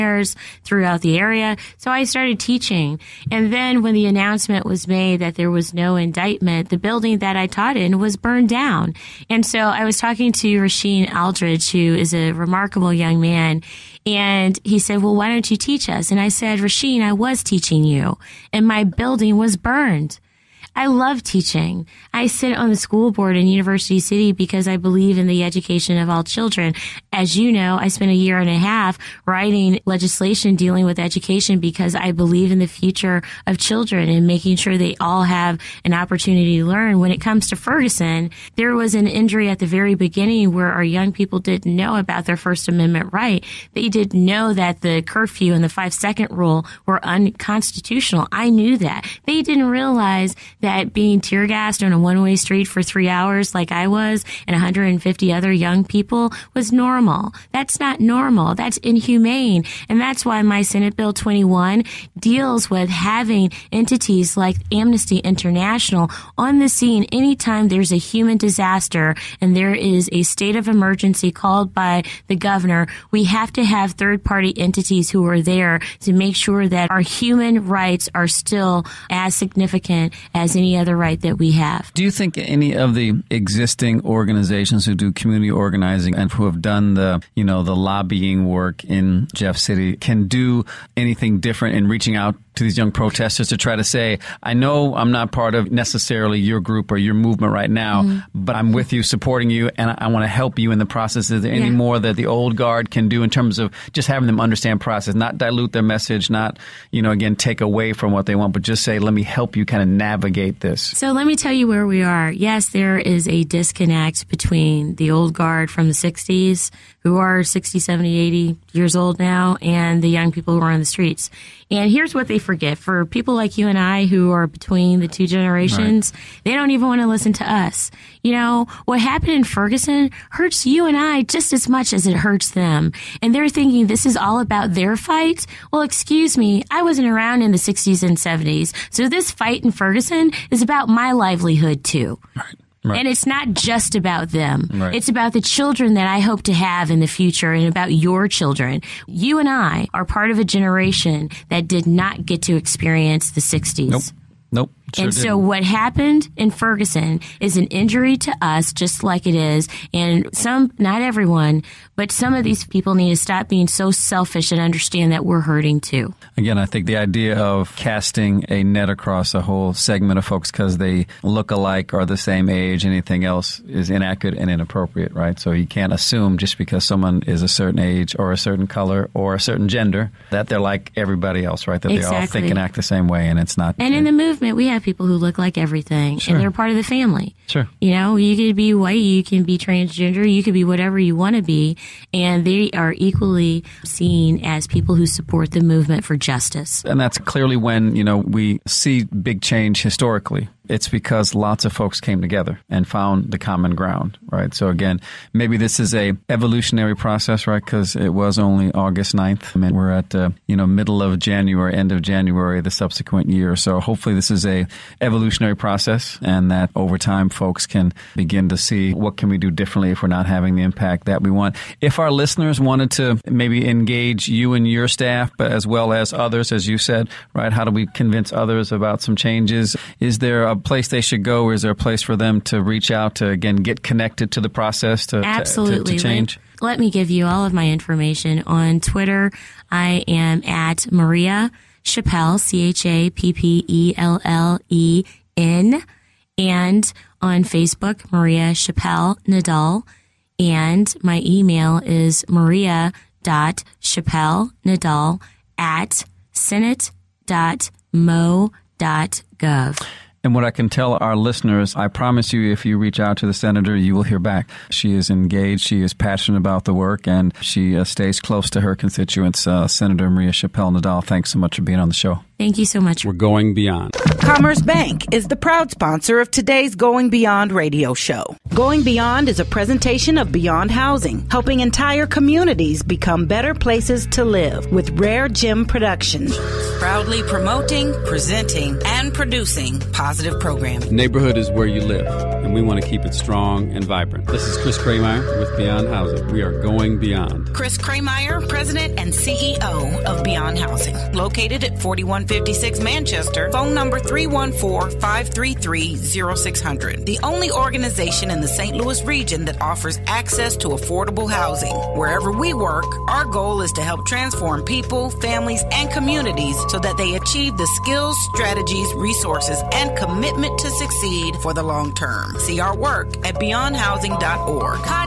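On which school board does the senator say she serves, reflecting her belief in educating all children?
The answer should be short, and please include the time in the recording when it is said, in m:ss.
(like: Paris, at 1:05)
University City, at 0:23.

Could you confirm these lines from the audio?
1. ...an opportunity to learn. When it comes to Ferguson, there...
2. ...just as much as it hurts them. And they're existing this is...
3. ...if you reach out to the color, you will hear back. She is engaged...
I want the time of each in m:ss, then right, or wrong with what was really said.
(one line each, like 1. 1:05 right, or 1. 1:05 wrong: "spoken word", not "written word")
1. 0:35 right
2. 2:11 wrong: "thinking", not "existing"
3. 4:22 wrong: "senator", not "color".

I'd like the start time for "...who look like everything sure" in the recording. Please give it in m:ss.
3:05.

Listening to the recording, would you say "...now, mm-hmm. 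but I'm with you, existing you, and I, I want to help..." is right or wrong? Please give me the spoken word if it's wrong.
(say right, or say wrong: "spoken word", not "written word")
wrong: "supporting", not "existing".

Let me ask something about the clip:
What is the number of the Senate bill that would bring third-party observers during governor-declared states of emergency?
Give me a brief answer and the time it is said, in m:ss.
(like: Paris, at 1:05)
21, at 1:00.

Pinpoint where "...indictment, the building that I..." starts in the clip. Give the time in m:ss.
0:05.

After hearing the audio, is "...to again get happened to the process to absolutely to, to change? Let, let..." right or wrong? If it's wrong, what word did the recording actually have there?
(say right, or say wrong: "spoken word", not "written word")
wrong: "connected", not "happened".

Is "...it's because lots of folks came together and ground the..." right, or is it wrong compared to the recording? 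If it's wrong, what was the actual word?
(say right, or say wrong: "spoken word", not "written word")
wrong: "found", not "ground".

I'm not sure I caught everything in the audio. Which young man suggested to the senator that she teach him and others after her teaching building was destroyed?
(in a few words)
Rasheen Aldridge.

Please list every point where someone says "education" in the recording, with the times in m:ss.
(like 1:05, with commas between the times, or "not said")
0:25, 0:30.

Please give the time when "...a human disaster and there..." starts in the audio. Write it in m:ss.
1:07.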